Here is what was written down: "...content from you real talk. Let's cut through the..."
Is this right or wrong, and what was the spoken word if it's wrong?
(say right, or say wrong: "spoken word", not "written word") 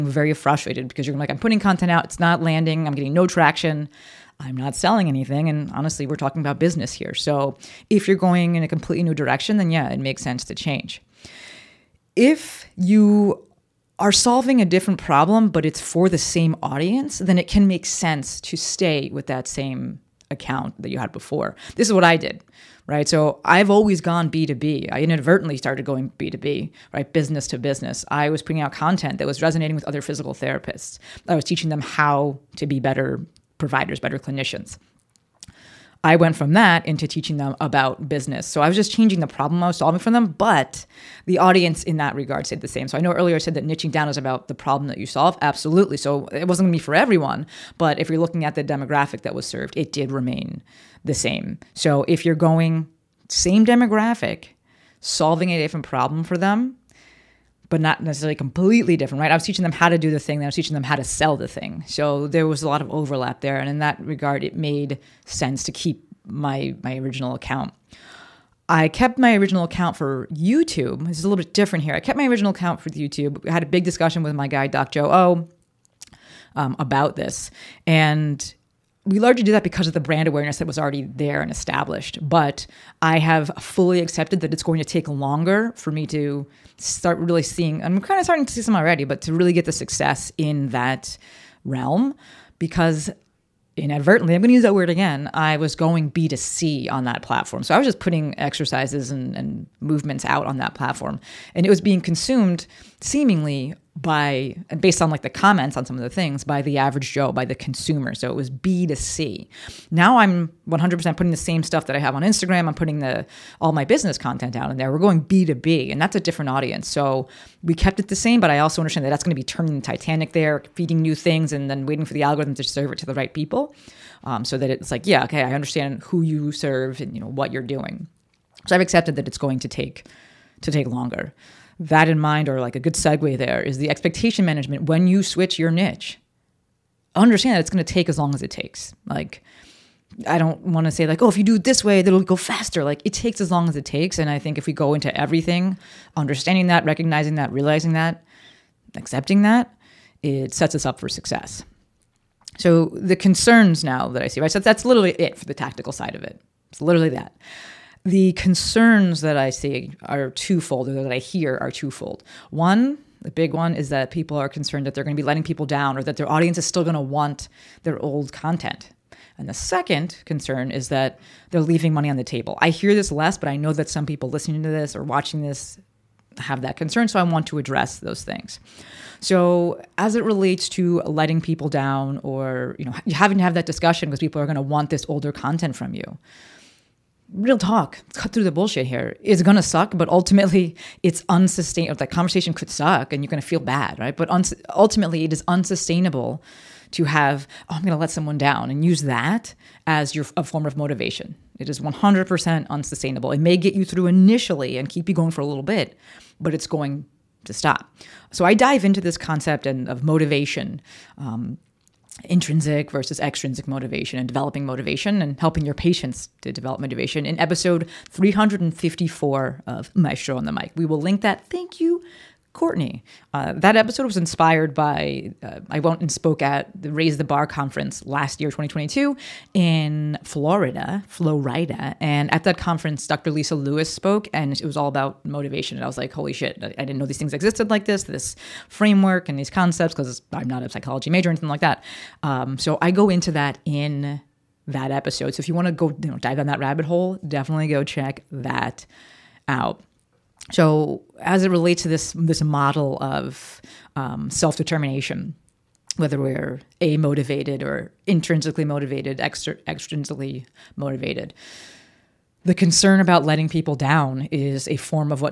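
right.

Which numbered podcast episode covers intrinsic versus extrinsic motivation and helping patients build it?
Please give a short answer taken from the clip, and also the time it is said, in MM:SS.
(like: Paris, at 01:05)
354, at 03:38.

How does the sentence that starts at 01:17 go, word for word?
And we largely do that because of the brand awareness that was already there and established.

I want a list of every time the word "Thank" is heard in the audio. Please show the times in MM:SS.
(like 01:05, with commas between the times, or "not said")
03:41.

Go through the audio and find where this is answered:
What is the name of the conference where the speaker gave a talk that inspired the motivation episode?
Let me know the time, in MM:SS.
03:46.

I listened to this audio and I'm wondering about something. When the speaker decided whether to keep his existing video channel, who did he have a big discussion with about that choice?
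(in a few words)
Doc Joe O.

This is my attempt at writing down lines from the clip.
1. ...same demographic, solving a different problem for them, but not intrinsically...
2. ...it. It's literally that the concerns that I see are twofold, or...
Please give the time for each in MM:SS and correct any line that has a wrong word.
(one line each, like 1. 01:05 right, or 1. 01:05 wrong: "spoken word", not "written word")
1. 00:53 wrong: "necessarily", not "intrinsically"
2. 02:36 right.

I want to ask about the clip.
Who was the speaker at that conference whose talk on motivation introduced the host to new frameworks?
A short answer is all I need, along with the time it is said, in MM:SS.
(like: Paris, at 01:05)
Dr. Lisa Lewis, at 03:53.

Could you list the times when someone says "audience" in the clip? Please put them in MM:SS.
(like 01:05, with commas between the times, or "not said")
00:16, 00:41, 01:56, 02:46.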